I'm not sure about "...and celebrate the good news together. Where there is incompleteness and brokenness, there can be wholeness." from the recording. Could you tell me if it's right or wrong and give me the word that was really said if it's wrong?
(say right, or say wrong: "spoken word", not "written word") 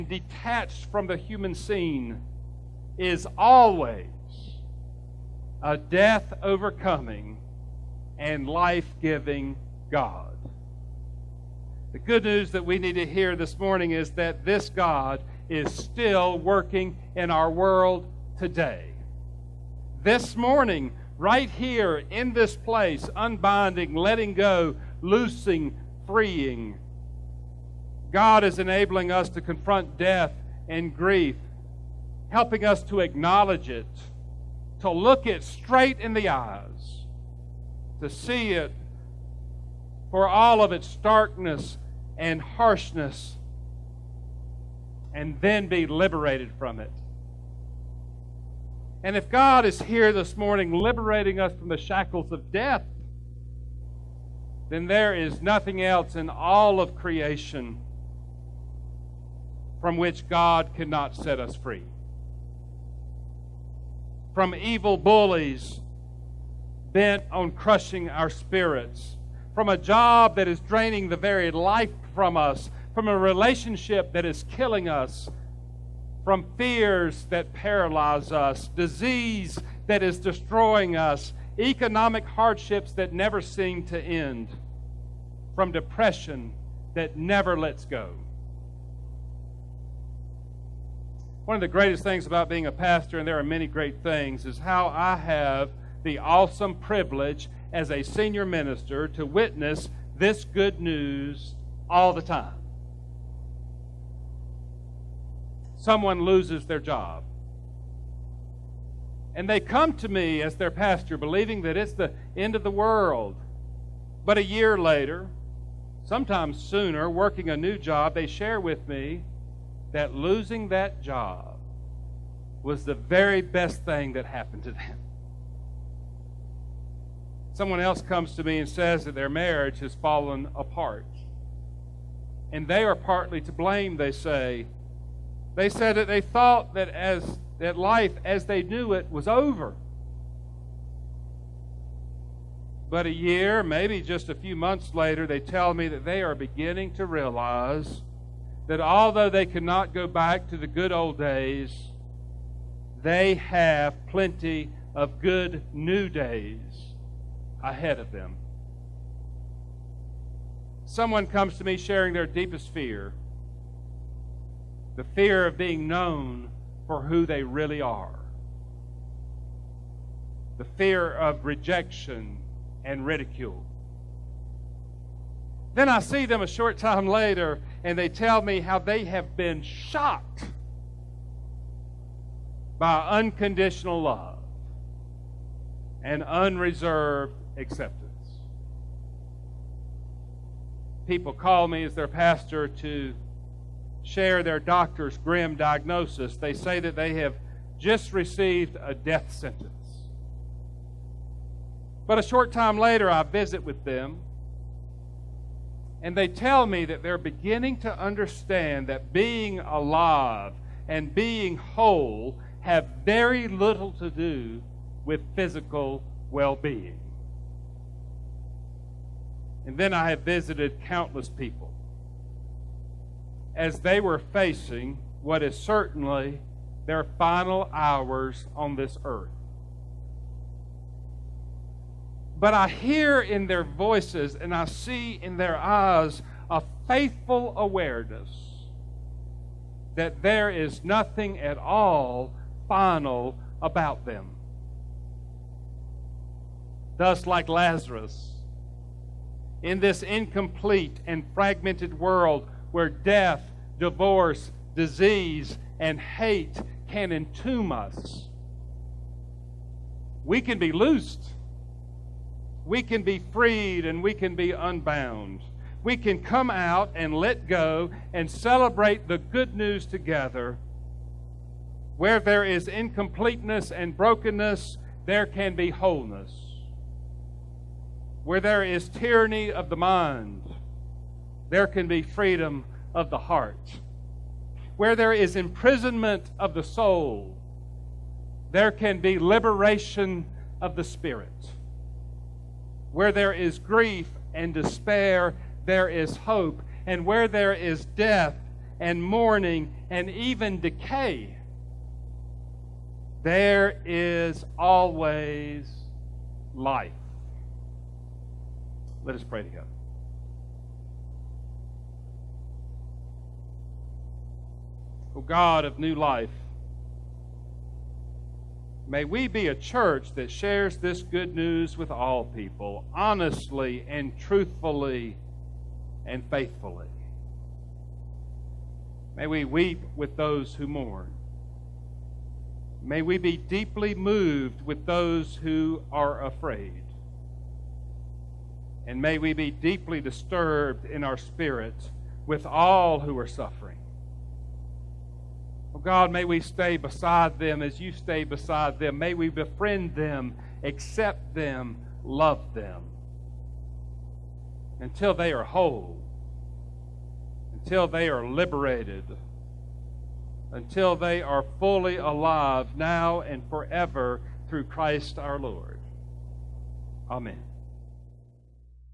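right.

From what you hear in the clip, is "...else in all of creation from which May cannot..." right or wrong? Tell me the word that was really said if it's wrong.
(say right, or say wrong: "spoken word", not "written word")
wrong: "God", not "May".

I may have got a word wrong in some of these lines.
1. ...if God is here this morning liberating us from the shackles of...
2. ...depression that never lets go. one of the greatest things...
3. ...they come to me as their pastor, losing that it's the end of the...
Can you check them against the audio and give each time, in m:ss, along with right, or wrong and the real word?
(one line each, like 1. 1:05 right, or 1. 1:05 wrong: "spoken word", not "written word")
1. 0:49 right
2. 1:25 right
3. 1:49 wrong: "believing", not "losing".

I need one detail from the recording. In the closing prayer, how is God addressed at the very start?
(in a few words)
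O God of new life.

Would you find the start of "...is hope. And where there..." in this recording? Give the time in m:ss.
4:55.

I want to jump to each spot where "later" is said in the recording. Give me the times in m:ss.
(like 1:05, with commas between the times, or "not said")
1:54, 2:24, 2:57, 3:22.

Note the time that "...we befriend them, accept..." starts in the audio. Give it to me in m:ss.
5:49.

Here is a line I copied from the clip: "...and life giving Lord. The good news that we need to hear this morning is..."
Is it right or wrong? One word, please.
wrong.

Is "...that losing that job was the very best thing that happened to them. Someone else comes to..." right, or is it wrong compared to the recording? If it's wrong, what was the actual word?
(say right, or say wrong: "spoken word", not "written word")
right.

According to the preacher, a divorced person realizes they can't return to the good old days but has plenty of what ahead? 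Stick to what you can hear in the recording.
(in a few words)
good new days.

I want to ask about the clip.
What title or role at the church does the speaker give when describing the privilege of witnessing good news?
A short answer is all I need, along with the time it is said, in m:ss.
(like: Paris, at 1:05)
senior minister, at 1:38.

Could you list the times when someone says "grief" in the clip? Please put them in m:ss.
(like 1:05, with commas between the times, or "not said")
0:30, 4:53.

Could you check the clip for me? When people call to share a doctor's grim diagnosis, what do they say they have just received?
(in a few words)
a death sentence.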